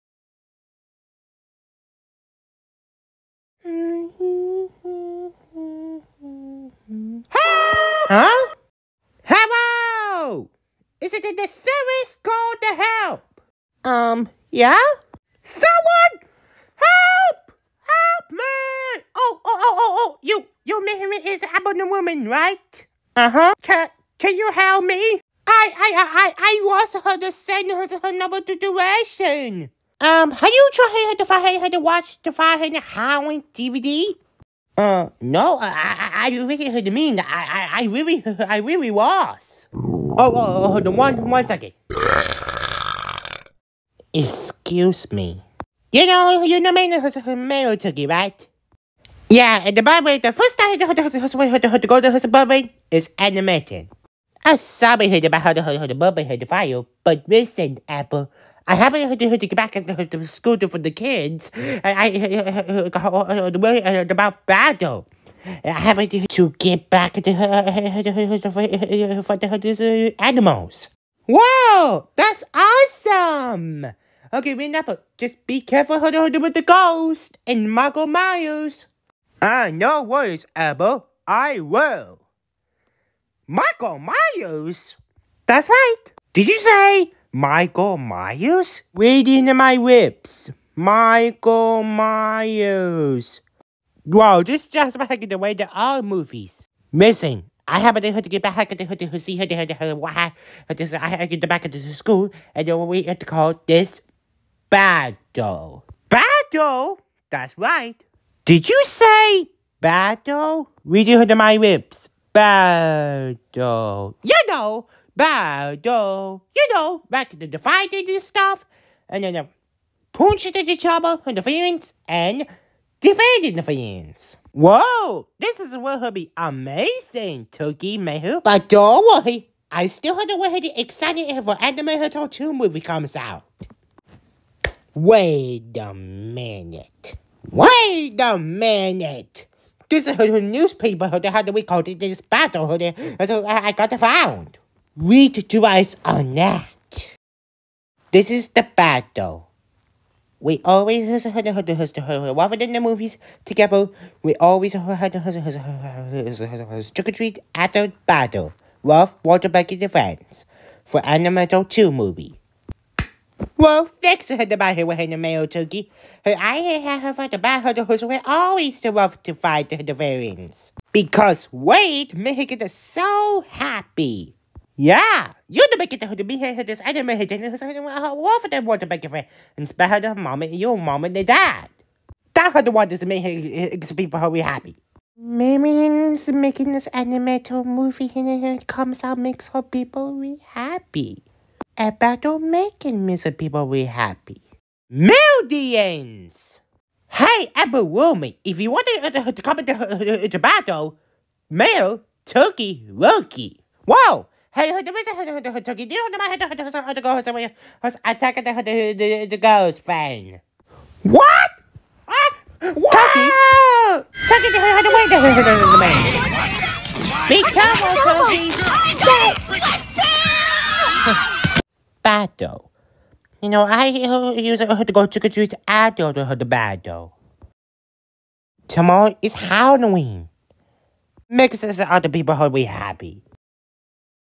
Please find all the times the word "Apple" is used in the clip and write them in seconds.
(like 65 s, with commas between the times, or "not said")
57 s, 197 s.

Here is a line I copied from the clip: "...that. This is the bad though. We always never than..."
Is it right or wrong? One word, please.
wrong.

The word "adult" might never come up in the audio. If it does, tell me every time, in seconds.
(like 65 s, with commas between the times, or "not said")
225 s.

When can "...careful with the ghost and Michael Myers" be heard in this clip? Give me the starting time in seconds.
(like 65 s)
75 s.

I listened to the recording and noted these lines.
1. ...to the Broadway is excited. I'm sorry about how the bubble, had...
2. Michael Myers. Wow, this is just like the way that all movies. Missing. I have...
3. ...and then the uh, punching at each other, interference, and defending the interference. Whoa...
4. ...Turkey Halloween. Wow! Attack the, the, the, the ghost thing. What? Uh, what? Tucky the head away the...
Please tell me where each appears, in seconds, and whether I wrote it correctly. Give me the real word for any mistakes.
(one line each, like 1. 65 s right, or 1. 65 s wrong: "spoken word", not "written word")
1. 52 s wrong: "animated", not "excited"
2. 90 s right
3. 119 s right
4. 202 s wrong: "Roki", not "Halloween".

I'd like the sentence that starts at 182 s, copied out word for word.
that's her the one that's making people who be happy.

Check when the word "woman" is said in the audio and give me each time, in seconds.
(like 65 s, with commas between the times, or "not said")
21 s, 197 s.